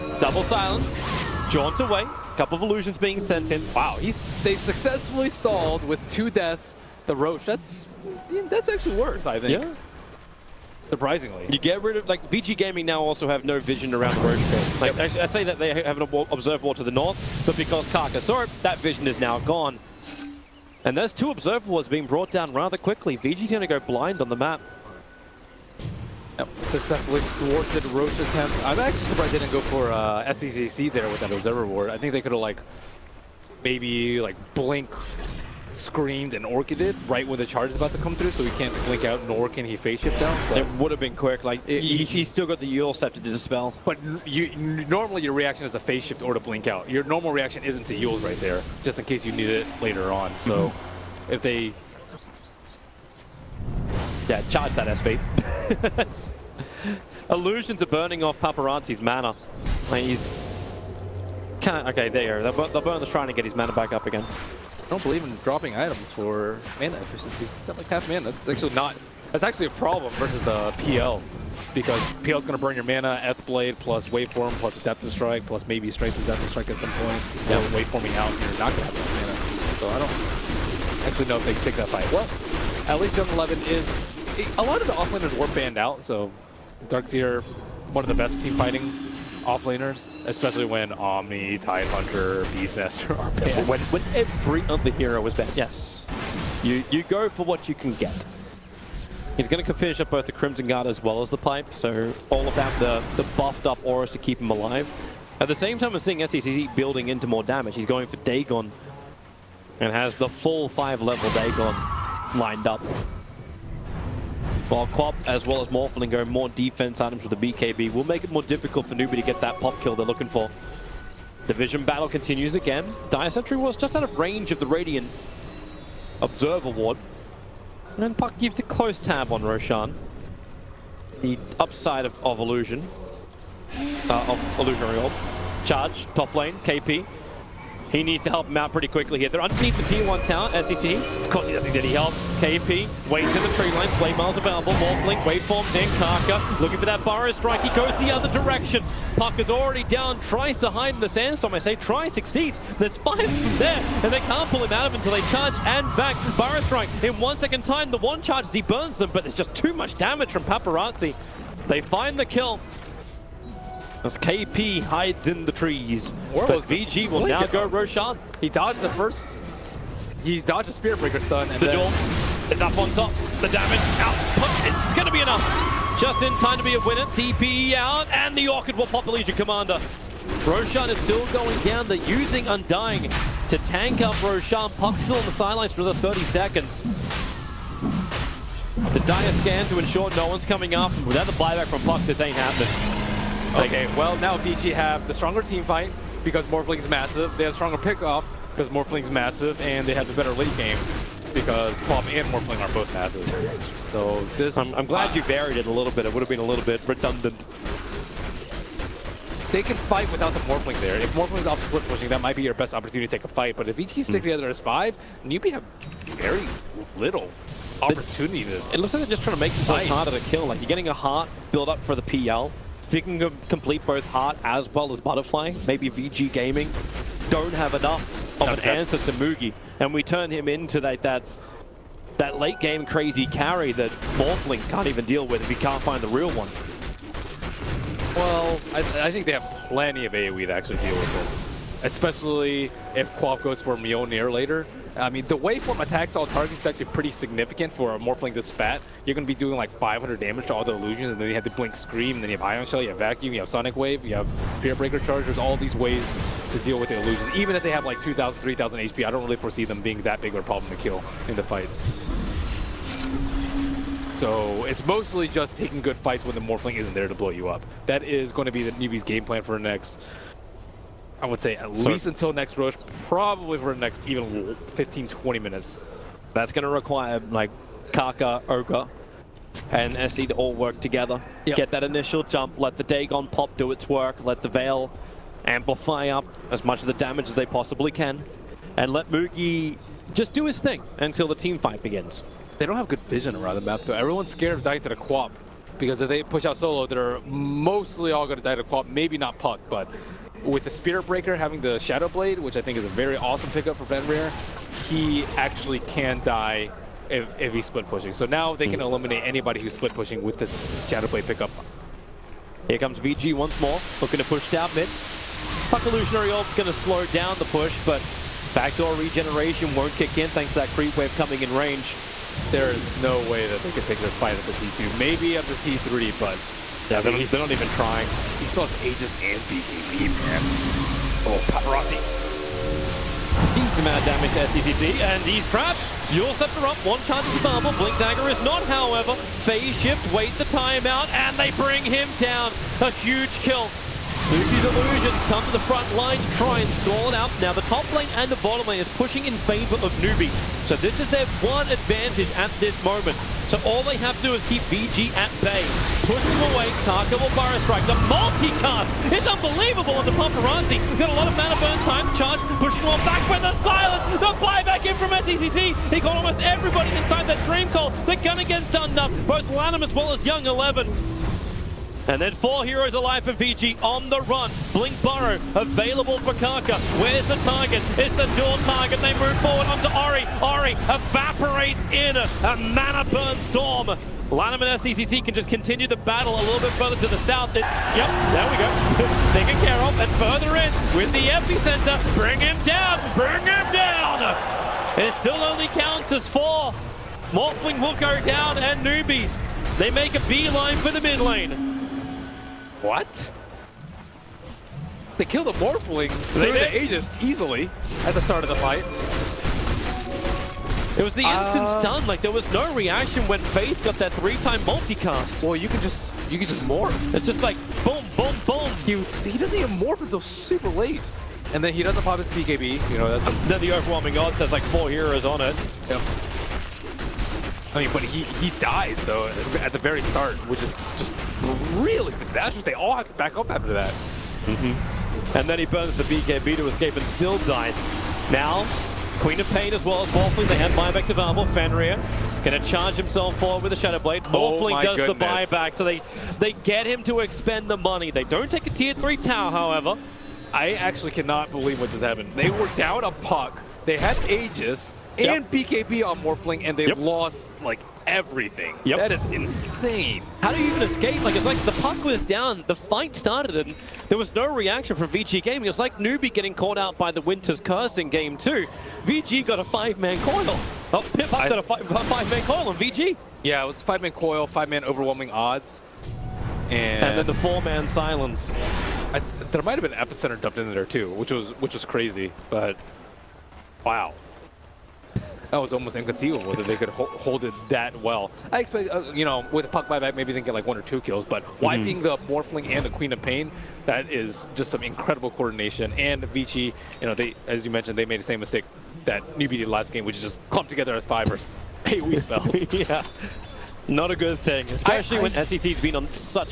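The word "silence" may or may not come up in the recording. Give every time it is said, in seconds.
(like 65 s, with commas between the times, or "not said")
0 s, 363 s, 477 s.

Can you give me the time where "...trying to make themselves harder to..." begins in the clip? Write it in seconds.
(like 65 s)
219 s.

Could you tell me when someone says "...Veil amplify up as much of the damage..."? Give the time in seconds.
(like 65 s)
284 s.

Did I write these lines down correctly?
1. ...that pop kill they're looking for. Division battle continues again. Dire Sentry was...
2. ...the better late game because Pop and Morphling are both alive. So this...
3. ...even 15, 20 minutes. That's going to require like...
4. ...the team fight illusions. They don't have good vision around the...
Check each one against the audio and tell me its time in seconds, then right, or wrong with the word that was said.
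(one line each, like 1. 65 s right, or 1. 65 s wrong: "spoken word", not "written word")
1. 119 s right
2. 200 s wrong: "massive", not "alive"
3. 274 s right
4. 291 s wrong: "begins", not "illusions".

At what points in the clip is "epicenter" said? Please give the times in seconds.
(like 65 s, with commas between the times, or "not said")
391 s, 479 s.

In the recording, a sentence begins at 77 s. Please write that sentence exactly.
Yeah, waveforming out, and you're not going to have enough mana.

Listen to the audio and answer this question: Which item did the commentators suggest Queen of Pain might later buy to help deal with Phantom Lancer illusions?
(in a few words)
Mjolnir.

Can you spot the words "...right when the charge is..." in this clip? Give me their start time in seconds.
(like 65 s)
37 s.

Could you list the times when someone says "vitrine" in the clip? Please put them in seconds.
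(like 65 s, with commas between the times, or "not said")
not said.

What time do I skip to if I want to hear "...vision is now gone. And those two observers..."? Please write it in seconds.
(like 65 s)
18 s.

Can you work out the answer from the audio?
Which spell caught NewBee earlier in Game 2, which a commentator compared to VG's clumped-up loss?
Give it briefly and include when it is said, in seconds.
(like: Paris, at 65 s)
Winter's Curse, at 467 s.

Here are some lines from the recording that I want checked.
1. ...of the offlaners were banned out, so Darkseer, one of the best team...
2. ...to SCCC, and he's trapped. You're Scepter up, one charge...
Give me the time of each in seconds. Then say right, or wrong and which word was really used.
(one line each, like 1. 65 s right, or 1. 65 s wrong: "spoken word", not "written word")
1. 84 s right
2. 334 s right.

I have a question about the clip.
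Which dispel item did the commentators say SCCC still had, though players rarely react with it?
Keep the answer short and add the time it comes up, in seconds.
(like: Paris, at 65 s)
Eul's Scepter, at 42 s.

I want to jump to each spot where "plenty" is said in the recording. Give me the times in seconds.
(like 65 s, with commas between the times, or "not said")
239 s.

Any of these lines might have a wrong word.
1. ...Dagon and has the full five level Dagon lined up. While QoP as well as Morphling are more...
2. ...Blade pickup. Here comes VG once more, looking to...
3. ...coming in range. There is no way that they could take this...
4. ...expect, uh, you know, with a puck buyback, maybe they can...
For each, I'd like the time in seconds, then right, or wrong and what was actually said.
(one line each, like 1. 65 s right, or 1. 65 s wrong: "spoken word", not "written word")
1. 108 s right
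2. 311 s right
3. 321 s right
4. 488 s right.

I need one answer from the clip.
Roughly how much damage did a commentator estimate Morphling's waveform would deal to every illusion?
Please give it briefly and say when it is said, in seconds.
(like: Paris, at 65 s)
500, at 249 s.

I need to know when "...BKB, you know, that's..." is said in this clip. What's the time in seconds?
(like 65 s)
422 s.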